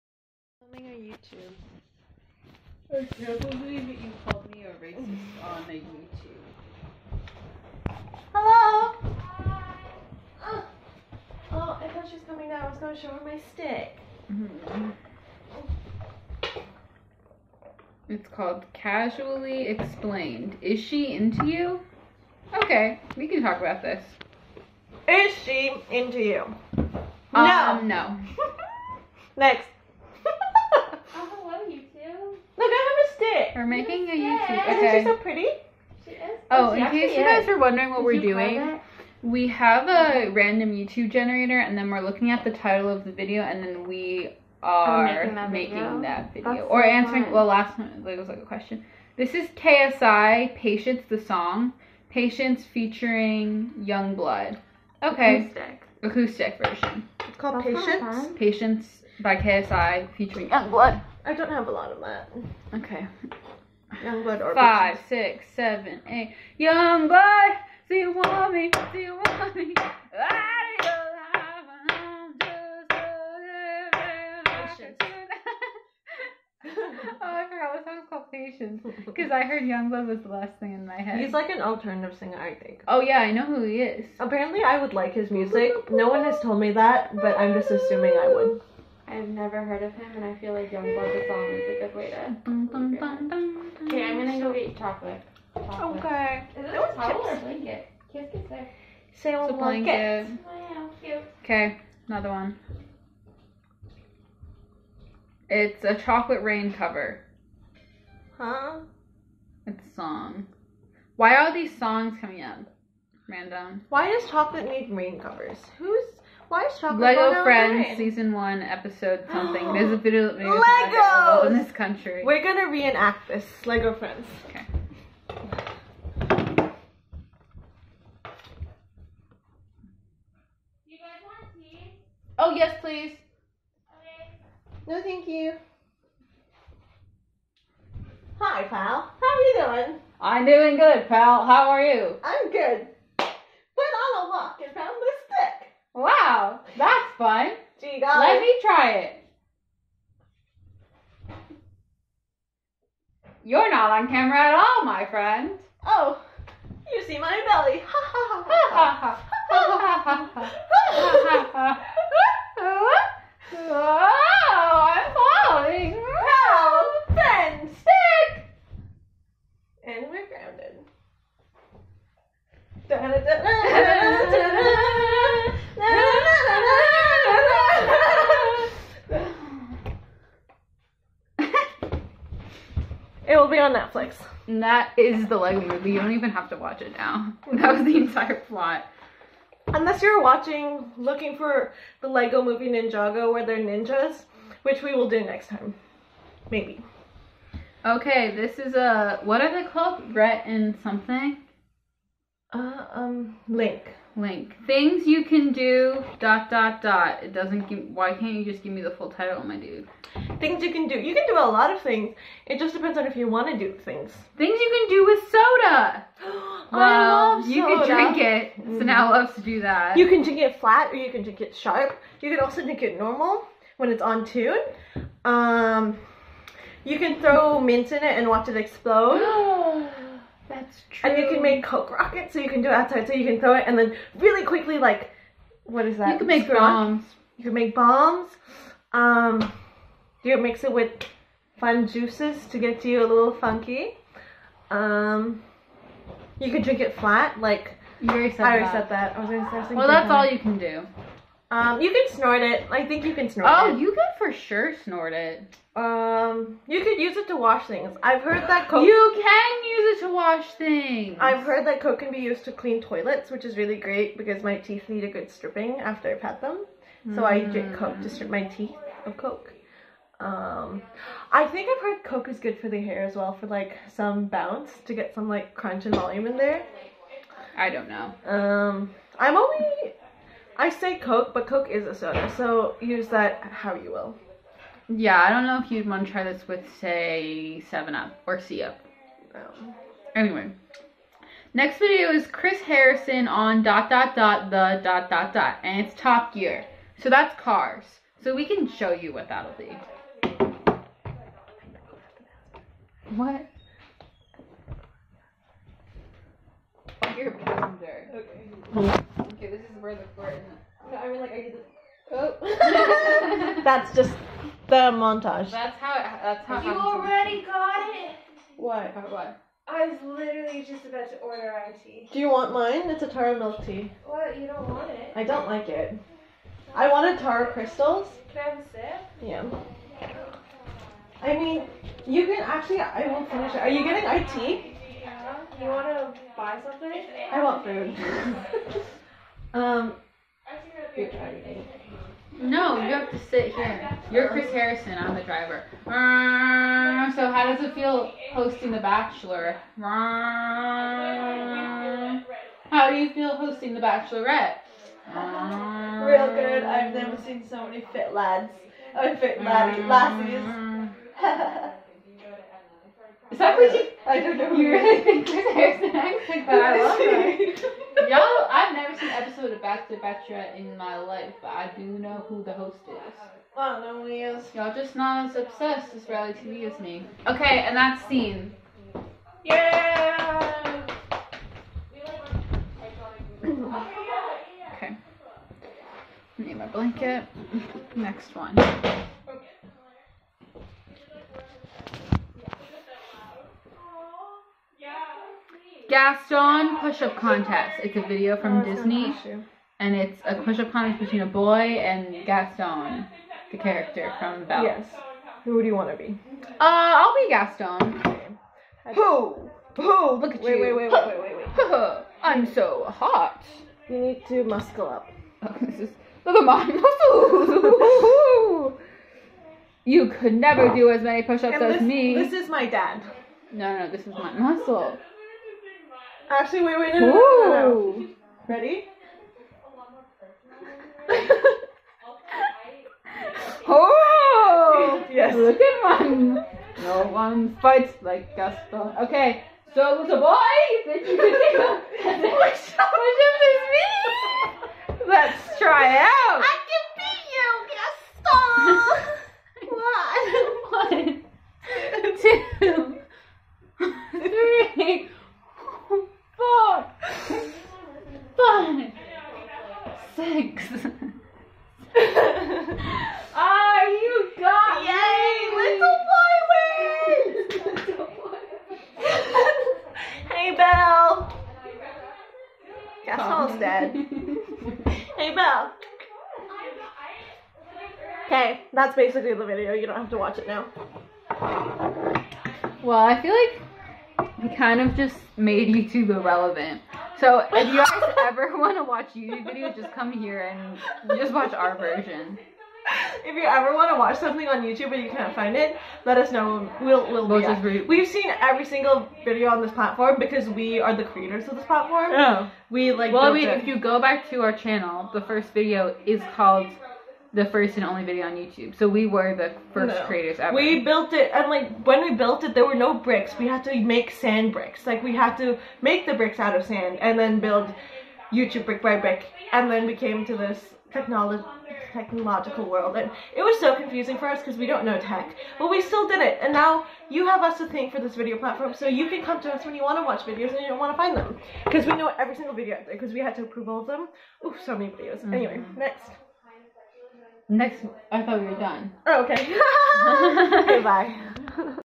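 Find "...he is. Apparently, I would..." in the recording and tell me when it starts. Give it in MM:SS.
01:23.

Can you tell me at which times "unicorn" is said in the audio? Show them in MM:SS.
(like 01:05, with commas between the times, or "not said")
not said.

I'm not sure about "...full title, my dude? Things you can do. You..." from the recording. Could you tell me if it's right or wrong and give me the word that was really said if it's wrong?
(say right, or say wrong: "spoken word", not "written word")
right.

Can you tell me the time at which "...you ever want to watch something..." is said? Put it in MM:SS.
08:13.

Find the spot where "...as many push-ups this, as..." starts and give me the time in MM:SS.
07:00.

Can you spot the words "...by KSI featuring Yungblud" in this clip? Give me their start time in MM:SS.
00:59.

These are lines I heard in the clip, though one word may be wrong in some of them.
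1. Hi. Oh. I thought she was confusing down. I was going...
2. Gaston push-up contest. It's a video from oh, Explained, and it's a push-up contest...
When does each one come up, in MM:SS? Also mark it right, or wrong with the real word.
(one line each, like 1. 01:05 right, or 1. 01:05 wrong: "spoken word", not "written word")
1. 00:10 wrong: "coming", not "confusing"
2. 06:35 wrong: "Disney", not "Explained".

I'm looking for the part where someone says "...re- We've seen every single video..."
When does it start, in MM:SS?
08:17.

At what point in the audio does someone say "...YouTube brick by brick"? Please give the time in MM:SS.
08:38.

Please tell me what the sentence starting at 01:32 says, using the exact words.
Bum, okay, I'm gonna go get chocolate.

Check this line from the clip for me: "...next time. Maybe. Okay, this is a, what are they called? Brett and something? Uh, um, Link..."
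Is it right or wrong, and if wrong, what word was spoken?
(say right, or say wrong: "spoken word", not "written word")
right.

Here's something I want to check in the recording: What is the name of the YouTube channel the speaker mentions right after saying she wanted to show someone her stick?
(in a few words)
Casually Explained.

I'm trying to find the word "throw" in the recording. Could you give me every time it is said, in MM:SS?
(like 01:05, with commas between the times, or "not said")
03:47, 03:53.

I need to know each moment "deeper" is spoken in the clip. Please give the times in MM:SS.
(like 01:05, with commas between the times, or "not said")
not said.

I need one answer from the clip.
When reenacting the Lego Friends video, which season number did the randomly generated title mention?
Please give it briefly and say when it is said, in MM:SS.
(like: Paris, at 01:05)
Season 1, at 01:57.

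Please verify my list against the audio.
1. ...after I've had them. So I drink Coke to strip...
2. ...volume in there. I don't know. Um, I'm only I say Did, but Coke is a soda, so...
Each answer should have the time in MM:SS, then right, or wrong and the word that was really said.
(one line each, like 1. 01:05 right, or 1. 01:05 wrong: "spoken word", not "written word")
1. 04:25 right
2. 04:35 wrong: "Coke", not "Did".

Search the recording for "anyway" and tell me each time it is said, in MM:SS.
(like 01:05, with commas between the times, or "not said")
04:50, 08:55.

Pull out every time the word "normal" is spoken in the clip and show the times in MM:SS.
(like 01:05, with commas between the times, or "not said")
03:42.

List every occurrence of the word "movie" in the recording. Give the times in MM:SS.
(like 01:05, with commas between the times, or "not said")
03:05, 03:12.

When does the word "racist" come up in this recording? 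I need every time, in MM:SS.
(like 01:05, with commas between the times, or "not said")
00:04.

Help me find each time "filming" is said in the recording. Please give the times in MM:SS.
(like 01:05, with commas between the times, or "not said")
00:00.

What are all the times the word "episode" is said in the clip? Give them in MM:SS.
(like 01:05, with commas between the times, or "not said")
01:58, 06:09.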